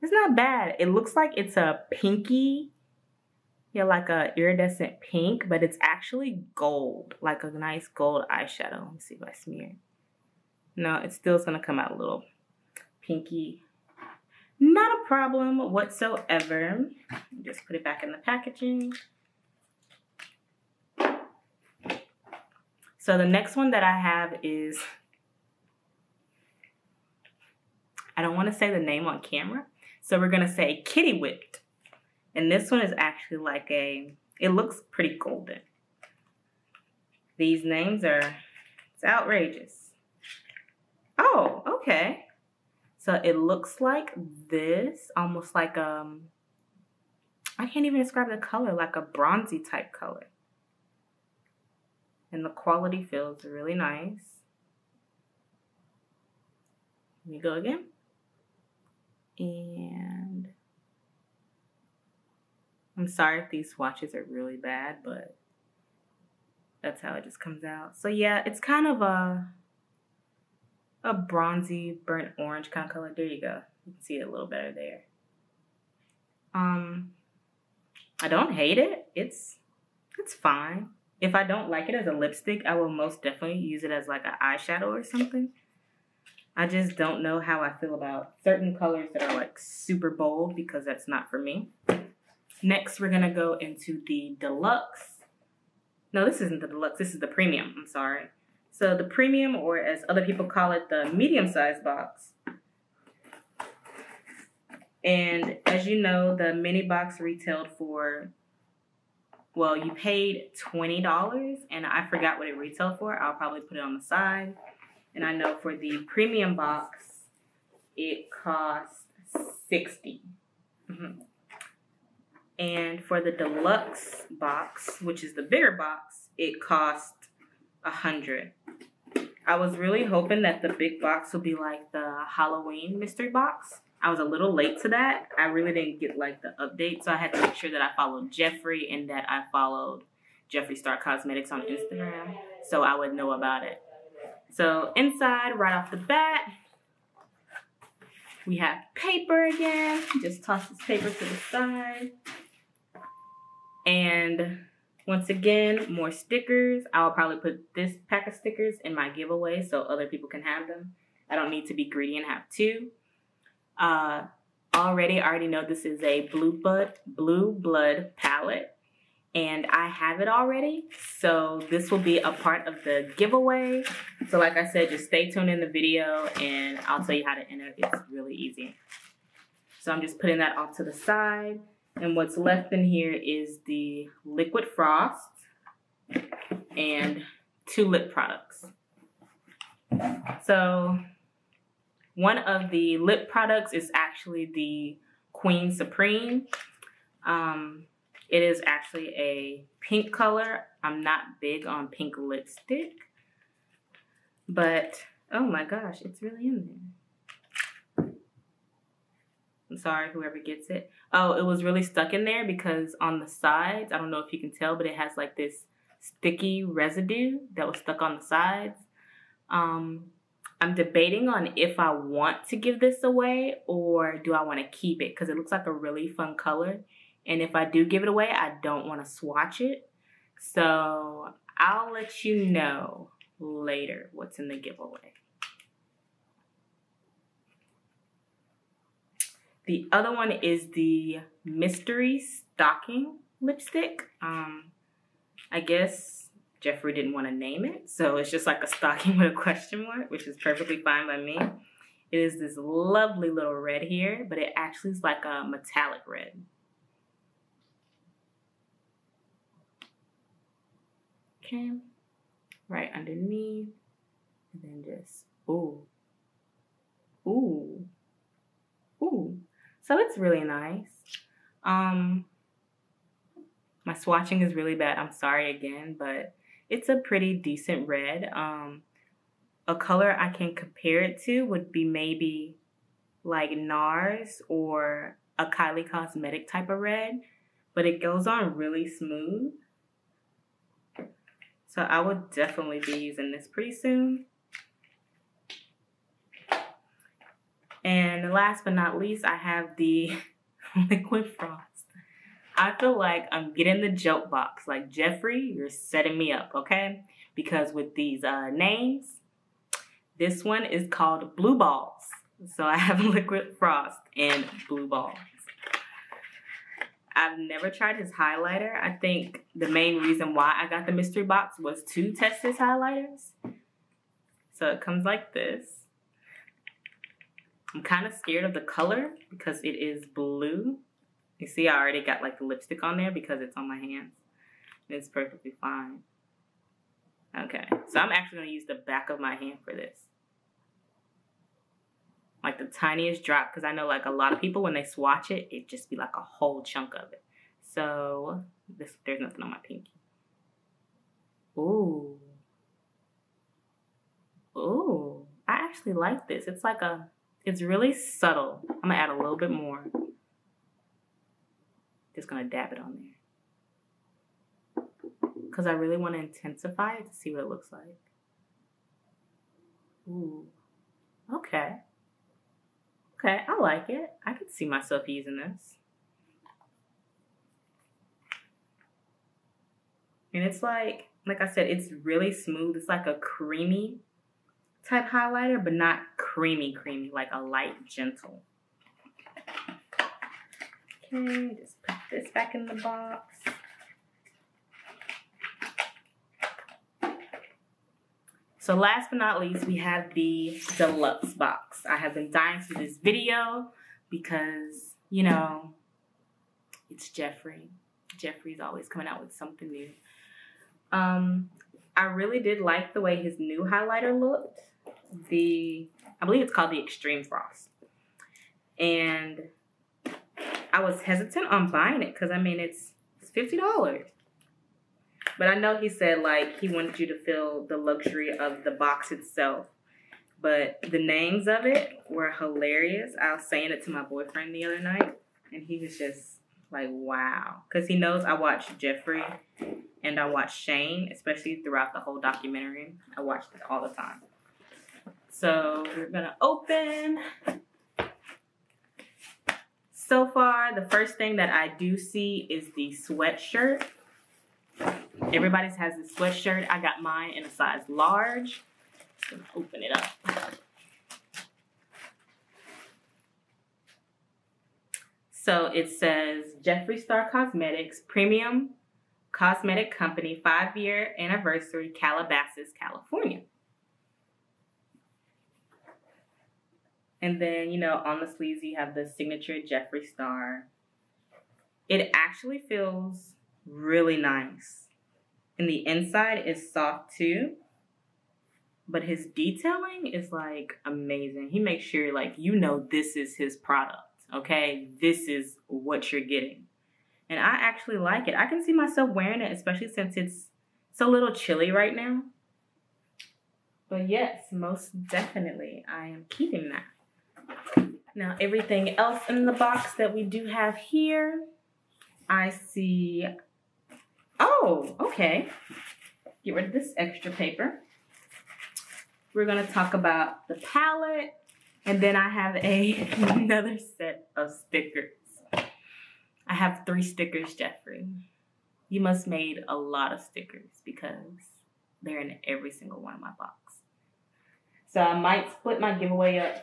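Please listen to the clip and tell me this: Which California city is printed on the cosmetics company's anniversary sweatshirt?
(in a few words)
Calabasas.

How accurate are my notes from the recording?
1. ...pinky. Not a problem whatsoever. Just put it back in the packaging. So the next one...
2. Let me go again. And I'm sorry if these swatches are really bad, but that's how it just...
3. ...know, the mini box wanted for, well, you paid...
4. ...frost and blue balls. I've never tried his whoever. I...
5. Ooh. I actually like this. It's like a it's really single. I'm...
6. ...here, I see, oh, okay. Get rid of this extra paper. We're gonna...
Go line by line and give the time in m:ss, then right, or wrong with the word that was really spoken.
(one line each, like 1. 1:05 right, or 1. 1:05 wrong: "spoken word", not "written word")
1. 0:13 right
2. 0:57 right
3. 1:46 wrong: "retailed", not "wanted"
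4. 5:13 wrong: "highlighter", not "whoever"
5. 5:54 wrong: "subtle", not "single"
6. 8:30 right.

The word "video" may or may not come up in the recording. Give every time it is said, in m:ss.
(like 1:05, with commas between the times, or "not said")
2:55, 6:42.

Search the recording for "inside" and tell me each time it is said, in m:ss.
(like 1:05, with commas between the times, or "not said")
2:24, 8:05.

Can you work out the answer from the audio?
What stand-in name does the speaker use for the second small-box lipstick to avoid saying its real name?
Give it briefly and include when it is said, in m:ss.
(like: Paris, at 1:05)
Kitty Whipped, at 0:30.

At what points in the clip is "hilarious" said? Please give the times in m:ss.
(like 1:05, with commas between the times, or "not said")
7:12.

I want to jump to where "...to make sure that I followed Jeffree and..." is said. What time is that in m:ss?
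2:17.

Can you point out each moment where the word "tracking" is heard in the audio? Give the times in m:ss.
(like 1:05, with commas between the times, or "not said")
not said.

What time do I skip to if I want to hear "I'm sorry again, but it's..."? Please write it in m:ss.
4:34.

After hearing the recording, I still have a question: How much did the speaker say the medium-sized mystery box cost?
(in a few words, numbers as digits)
$60.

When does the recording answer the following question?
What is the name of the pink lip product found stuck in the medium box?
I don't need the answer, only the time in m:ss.
3:15.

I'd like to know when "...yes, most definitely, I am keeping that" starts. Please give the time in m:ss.
8:24.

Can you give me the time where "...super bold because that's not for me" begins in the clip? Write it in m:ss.
1:29.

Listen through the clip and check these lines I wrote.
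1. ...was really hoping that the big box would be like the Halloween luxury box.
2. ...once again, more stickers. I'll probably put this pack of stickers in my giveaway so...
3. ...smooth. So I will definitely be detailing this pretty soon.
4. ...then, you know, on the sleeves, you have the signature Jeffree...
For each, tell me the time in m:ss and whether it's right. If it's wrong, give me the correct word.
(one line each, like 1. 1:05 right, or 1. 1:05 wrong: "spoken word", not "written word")
1. 2:09 wrong: "mystery", not "luxury"
2. 2:35 right
3. 4:48 wrong: "using", not "detailing"
4. 7:57 right.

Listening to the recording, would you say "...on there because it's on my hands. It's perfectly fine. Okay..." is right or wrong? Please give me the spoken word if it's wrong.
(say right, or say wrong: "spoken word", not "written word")
right.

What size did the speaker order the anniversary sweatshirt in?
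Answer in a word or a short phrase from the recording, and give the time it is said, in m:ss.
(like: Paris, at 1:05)
Large, at 7:37.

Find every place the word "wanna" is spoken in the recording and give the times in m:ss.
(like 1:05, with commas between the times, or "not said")
0:28, 6:05.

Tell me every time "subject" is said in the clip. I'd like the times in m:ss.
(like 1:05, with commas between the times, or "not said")
not said.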